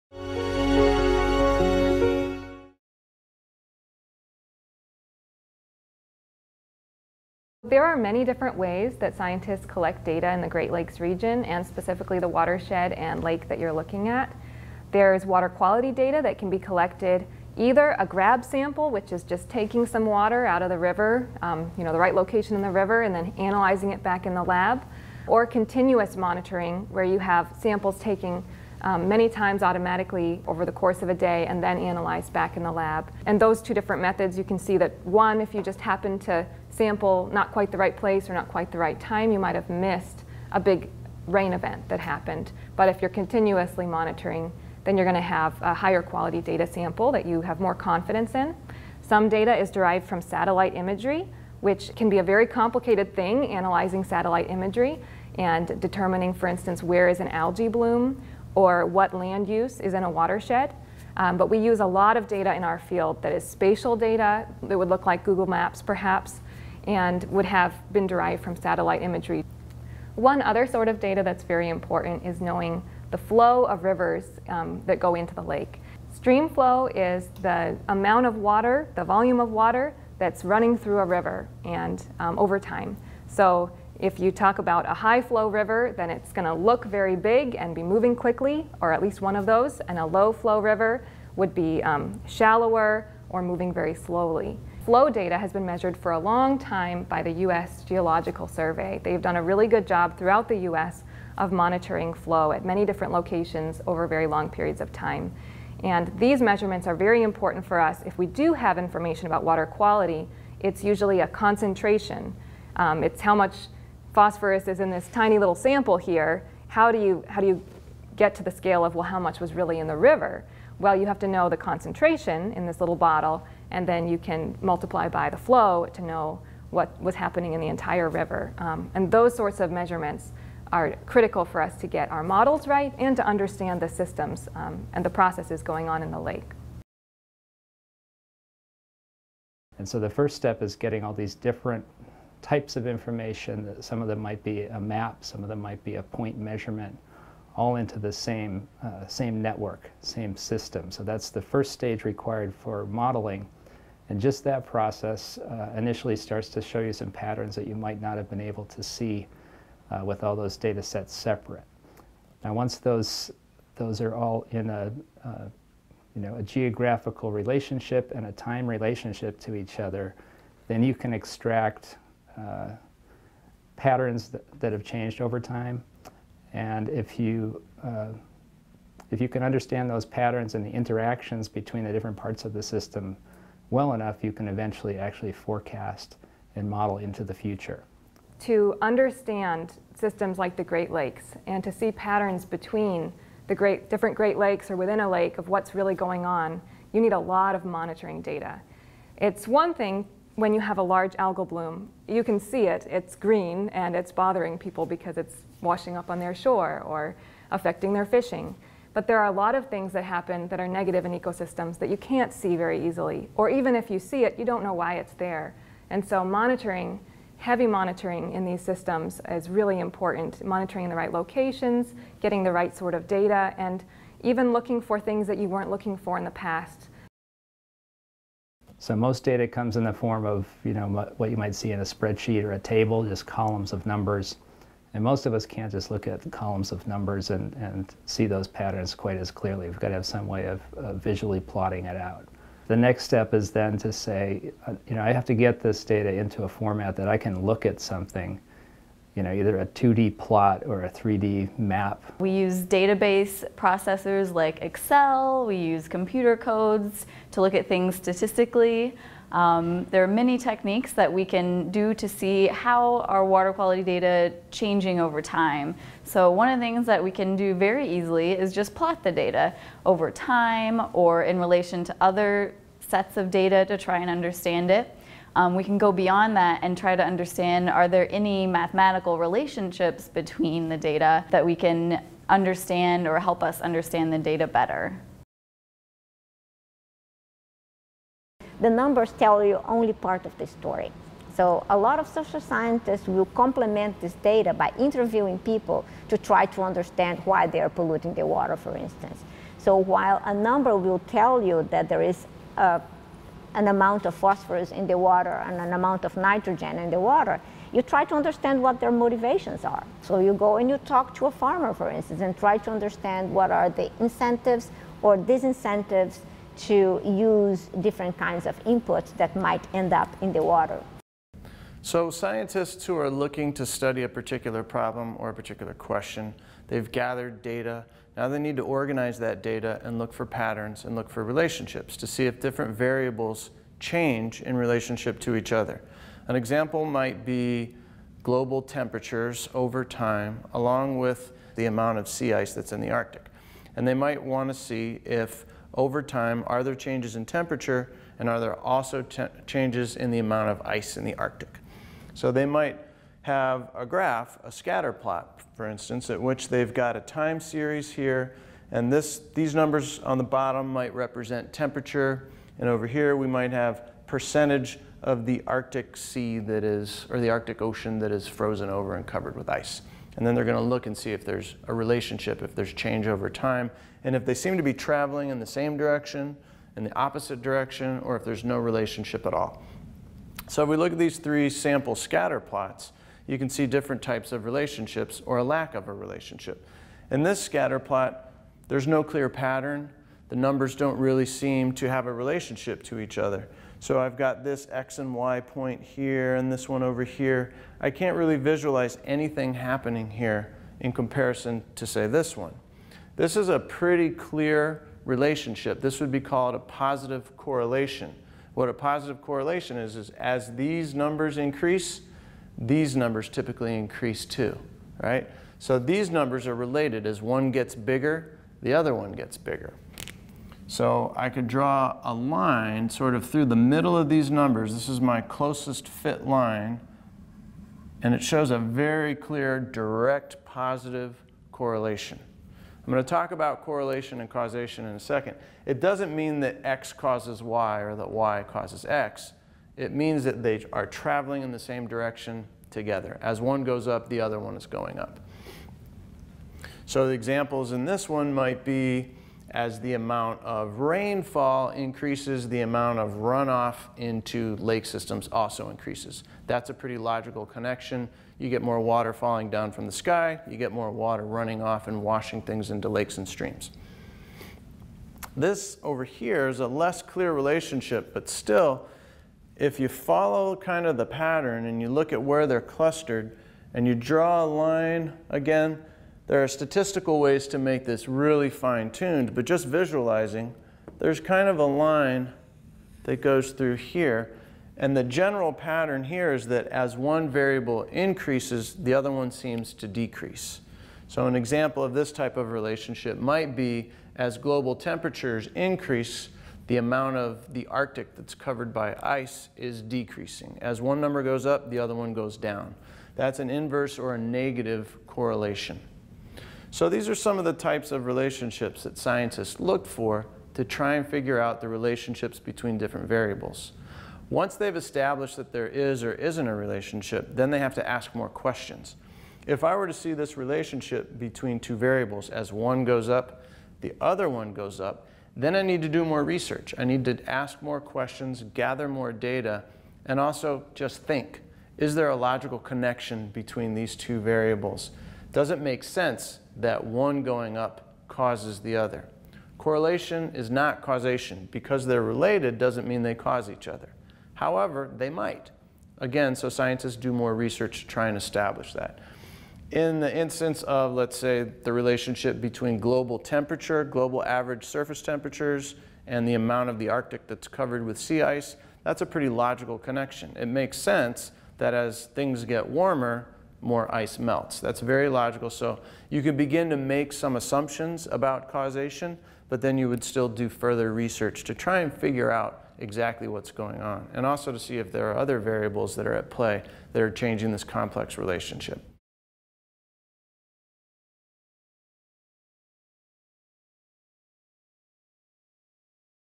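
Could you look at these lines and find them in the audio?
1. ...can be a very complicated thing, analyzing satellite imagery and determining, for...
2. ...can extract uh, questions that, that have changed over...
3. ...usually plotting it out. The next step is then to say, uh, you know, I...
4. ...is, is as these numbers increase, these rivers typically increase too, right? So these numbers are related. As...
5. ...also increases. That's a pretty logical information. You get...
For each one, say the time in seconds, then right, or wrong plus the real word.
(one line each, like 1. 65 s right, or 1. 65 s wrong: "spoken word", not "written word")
1. 51 s right
2. 170 s wrong: "patterns", not "questions"
3. 241 s wrong: "visually", not "usually"
4. 409 s wrong: "numbers", not "rivers"
5. 455 s wrong: "connection", not "information".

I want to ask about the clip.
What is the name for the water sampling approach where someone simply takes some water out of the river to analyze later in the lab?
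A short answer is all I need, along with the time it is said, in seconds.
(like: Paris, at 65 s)
Grab sample, at 18 s.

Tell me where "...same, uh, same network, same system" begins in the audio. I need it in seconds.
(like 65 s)
148 s.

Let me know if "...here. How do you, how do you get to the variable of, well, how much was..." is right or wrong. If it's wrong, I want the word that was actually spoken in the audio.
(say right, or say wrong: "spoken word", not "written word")
wrong: "scale", not "variable".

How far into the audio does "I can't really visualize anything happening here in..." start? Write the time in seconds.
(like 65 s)
397 s.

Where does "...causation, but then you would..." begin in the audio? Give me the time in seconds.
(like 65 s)
568 s.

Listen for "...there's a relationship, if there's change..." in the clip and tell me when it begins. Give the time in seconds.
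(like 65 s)
371 s.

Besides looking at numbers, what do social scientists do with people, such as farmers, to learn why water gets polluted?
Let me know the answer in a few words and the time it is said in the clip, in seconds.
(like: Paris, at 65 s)
Interviewing, at 294 s.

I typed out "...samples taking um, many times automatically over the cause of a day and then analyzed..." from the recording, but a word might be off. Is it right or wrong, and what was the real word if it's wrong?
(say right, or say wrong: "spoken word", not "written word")
wrong: "course", not "cause".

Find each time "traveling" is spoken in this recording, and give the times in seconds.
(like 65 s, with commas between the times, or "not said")
374 s, 440 s.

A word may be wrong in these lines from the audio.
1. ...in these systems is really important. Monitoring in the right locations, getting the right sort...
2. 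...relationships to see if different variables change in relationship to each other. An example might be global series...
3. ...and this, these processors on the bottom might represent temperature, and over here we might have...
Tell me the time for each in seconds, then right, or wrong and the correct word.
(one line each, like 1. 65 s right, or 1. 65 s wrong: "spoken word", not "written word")
1. 218 s right
2. 331 s wrong: "temperatures", not "series"
3. 358 s wrong: "numbers", not "processors".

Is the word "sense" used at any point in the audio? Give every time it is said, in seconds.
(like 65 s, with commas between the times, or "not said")
535 s, 560 s.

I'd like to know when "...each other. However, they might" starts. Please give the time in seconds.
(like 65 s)
543 s.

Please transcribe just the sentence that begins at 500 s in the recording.
As one number goes up, the other one goes down.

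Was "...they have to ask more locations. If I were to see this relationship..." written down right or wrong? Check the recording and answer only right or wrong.
wrong.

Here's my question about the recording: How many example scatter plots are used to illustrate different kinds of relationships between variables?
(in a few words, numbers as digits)
3.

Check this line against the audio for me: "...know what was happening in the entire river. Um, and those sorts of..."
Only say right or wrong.
right.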